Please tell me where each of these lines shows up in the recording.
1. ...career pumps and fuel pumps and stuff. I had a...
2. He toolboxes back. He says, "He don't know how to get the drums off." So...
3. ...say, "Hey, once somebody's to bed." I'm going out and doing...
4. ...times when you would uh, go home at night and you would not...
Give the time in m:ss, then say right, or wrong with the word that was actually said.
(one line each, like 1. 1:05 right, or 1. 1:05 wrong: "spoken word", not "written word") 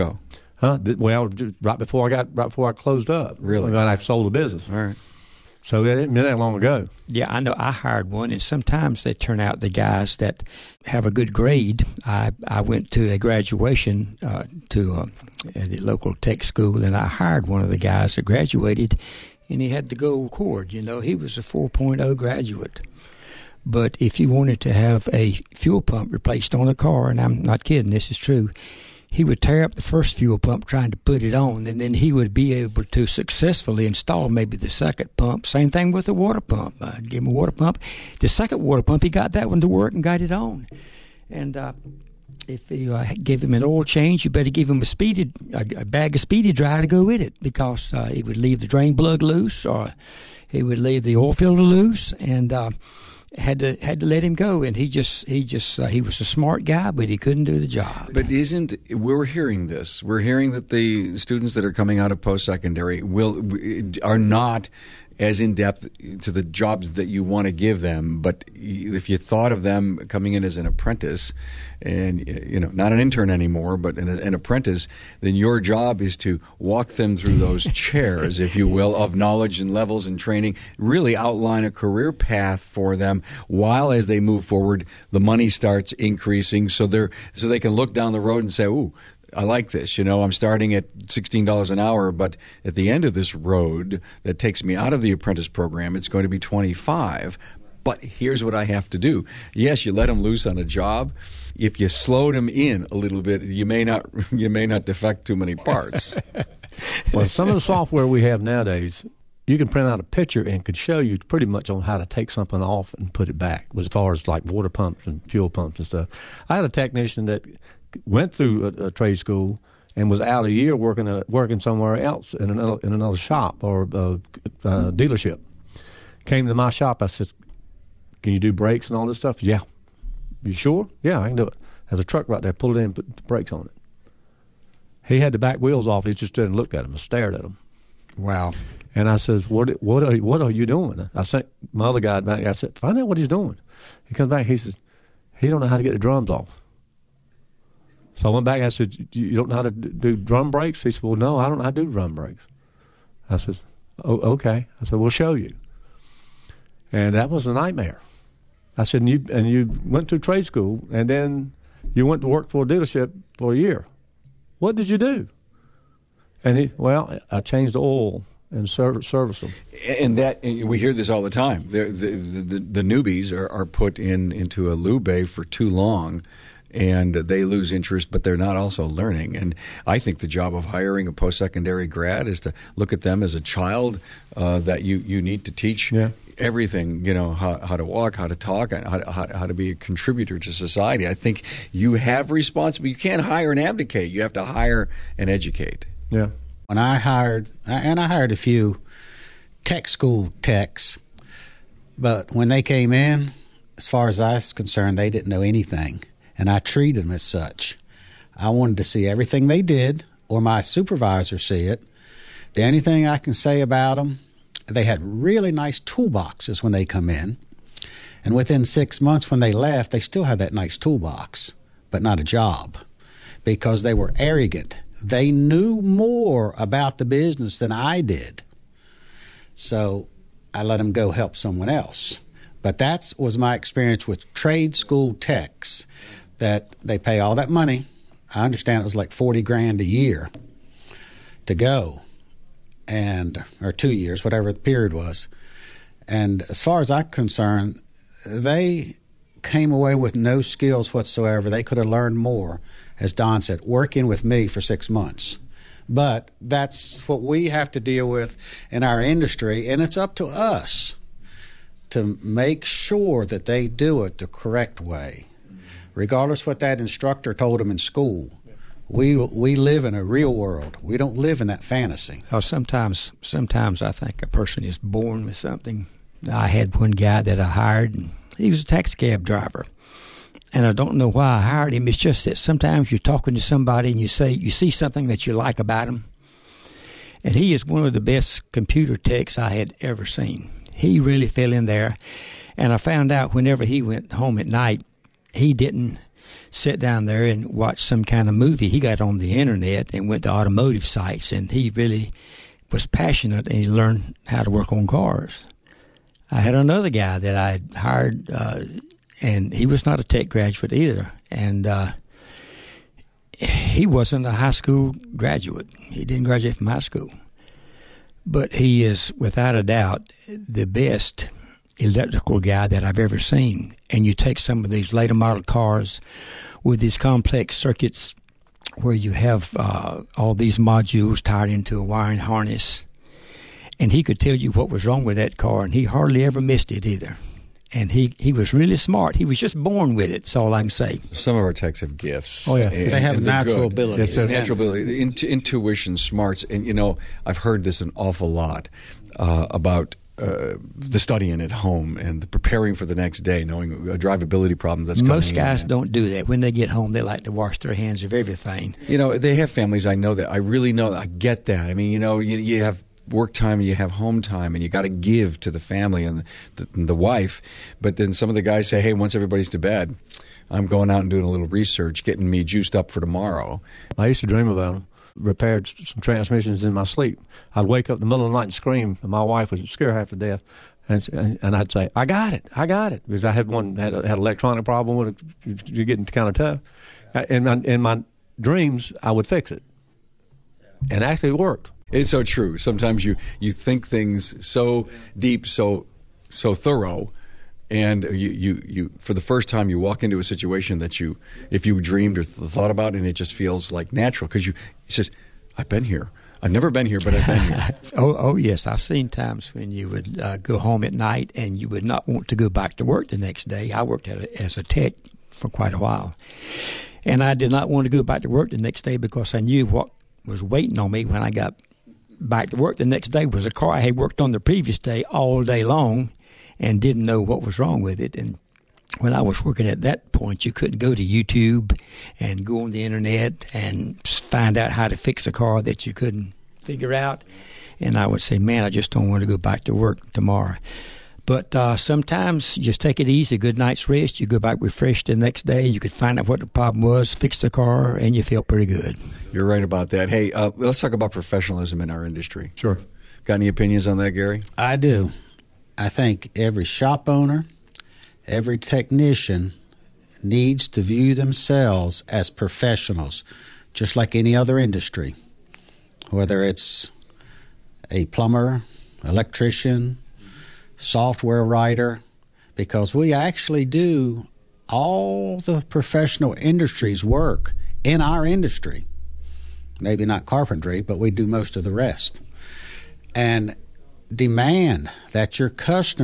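1. 1:54 wrong: "water", not "career"
2. 2:24 wrong: "comes", not "toolboxes"
3. 6:08 wrong: "everybody", not "somebody"
4. 6:49 right.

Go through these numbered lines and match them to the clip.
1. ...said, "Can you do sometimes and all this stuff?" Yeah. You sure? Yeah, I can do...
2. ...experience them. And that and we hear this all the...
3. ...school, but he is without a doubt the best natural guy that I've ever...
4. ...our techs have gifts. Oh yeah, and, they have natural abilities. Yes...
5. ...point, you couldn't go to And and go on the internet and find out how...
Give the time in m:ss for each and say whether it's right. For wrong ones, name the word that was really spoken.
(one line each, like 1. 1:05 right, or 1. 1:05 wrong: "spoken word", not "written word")
1. 2:07 wrong: "brakes", not "sometimes"
2. 2:49 wrong: "service", not "experience"
3. 5:16 wrong: "electrical", not "natural"
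4. 5:41 right
5. 7:10 wrong: "YouTube", not "And".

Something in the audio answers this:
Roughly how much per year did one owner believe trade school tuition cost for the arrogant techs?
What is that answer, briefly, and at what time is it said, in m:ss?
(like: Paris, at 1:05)
40 grand, at 3:59.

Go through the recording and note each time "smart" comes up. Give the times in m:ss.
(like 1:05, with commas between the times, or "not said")
0:56, 5:38, 5:45.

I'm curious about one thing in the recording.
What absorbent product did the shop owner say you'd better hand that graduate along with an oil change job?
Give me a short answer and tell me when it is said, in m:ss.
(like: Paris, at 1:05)
speedy dry, at 0:46.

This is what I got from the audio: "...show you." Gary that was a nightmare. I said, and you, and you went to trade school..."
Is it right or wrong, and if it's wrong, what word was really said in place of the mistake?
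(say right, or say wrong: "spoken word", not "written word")
wrong: "And", not "Gary".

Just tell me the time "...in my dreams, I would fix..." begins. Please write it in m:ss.
6:27.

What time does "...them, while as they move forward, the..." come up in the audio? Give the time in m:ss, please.
1:22.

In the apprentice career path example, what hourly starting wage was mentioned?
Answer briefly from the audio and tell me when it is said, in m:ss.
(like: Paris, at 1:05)
$16, at 1:30.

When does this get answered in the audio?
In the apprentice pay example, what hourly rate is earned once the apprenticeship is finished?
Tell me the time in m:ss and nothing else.
1:36.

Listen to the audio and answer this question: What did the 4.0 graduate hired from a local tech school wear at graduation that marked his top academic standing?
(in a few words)
gold cord.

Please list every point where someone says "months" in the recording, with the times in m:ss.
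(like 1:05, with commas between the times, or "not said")
3:39, 4:14.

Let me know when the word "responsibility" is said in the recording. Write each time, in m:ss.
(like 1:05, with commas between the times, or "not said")
3:12.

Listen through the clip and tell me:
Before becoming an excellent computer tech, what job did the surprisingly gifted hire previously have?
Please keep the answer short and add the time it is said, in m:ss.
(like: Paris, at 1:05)
taxi cab driver, at 4:38.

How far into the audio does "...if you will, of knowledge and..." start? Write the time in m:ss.
1:18.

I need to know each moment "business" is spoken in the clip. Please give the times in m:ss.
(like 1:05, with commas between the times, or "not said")
0:04, 3:47.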